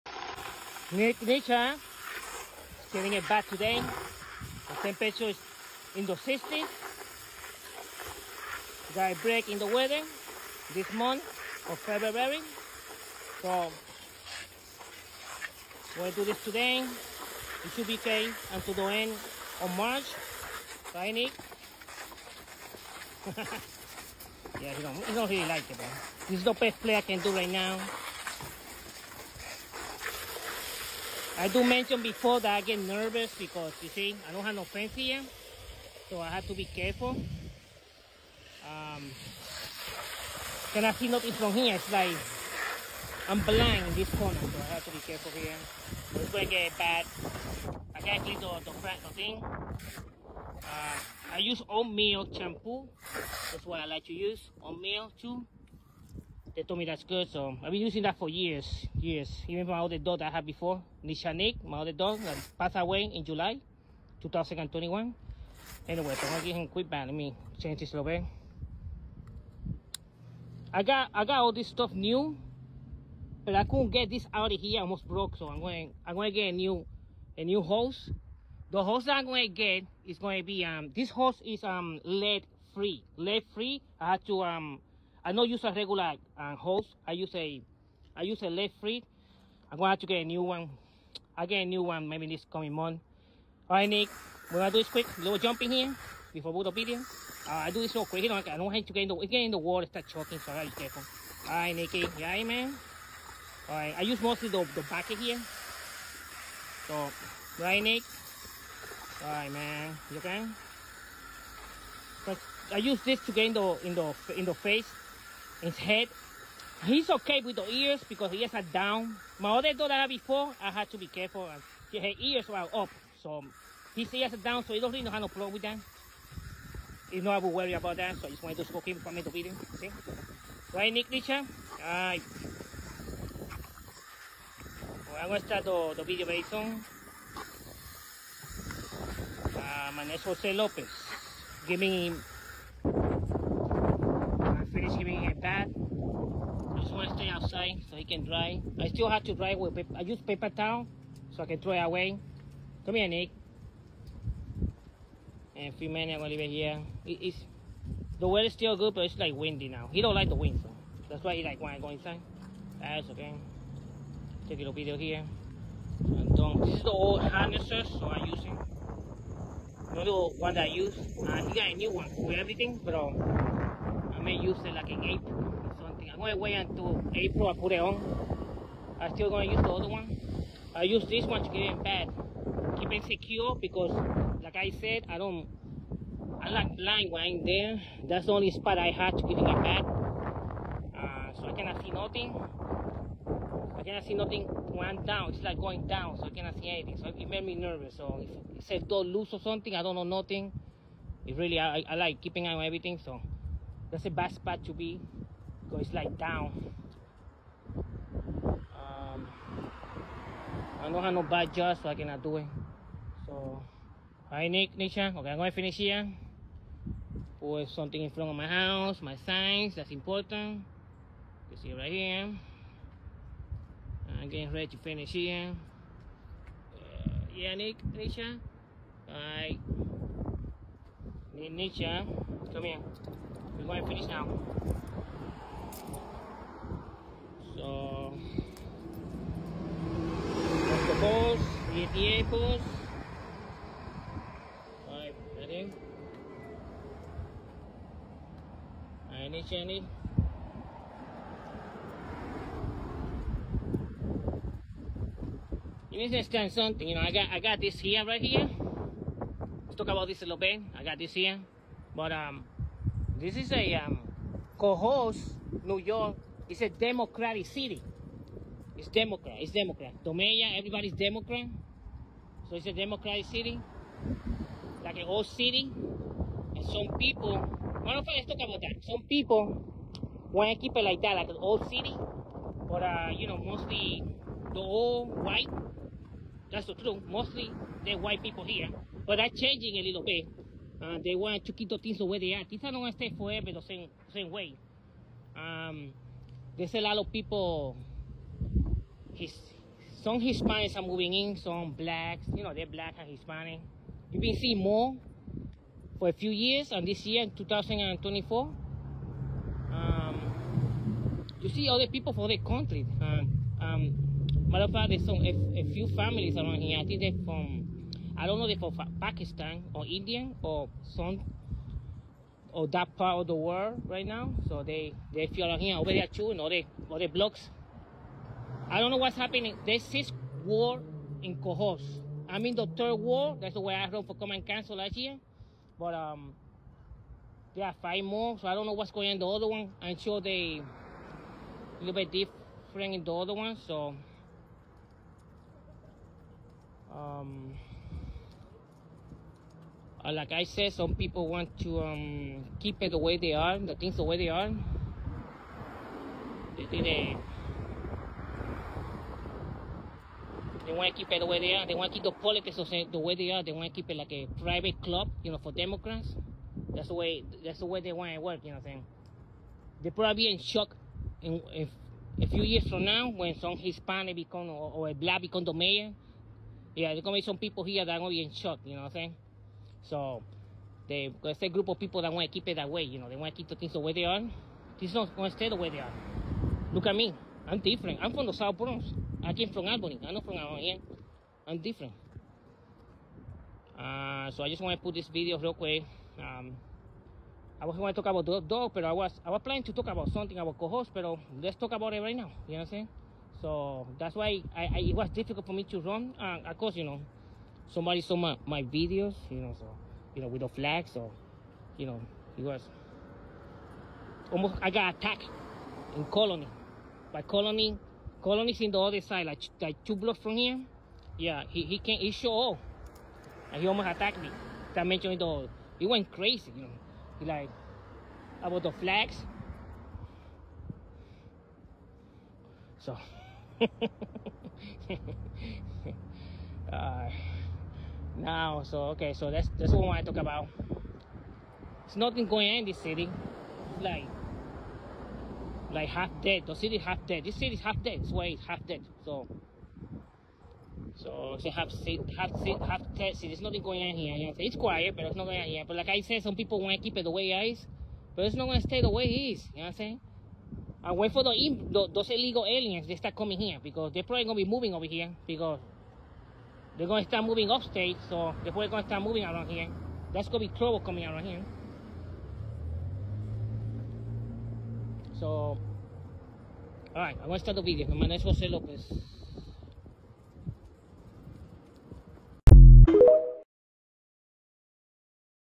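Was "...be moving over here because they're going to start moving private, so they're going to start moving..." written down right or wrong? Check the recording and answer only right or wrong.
wrong.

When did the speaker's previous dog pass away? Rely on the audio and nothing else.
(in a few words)
July 2021.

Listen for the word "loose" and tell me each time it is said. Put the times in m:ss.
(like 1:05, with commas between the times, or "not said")
3:19.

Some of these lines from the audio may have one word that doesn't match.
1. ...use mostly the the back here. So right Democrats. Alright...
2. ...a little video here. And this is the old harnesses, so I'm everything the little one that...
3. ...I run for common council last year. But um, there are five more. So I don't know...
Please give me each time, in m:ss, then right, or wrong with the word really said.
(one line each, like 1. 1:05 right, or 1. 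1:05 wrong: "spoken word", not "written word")
1. 1:44 wrong: "Nick", not "Democrats"
2. 2:44 wrong: "using", not "everything"
3. 5:33 right.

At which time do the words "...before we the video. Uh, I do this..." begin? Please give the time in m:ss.
1:36.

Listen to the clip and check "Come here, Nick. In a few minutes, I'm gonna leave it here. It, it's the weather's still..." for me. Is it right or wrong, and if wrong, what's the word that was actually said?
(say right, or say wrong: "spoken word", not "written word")
right.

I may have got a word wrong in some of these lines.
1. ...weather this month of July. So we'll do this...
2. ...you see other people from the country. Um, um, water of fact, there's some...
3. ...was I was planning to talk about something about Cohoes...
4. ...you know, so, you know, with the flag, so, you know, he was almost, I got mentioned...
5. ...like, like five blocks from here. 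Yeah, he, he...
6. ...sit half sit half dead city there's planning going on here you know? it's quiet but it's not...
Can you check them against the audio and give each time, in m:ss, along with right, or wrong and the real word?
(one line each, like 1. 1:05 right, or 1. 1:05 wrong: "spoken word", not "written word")
1. 0:09 wrong: "February", not "July"
2. 5:11 wrong: "matter", not "water"
3. 6:38 right
4. 6:49 wrong: "attacked", not "mentioned"
5. 6:59 wrong: "two", not "five"
6. 7:31 wrong: "nothing", not "planning".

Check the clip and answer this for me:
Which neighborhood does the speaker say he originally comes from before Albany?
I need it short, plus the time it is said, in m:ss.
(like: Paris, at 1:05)
South Bronx, at 6:28.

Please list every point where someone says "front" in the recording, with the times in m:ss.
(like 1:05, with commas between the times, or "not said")
0:48, 3:38.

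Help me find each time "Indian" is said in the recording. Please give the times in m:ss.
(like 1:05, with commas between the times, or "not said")
5:19.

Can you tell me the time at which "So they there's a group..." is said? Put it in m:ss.
6:19.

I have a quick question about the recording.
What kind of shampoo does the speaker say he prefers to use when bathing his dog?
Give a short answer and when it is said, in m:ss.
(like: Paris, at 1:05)
Oatmeal shampoo, at 0:51.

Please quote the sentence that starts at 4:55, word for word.
Um, there's a lot of people, his, some Hispanics are moving in, some blacks, you know, they're black and Hispanic.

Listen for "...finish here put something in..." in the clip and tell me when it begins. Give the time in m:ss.
3:35.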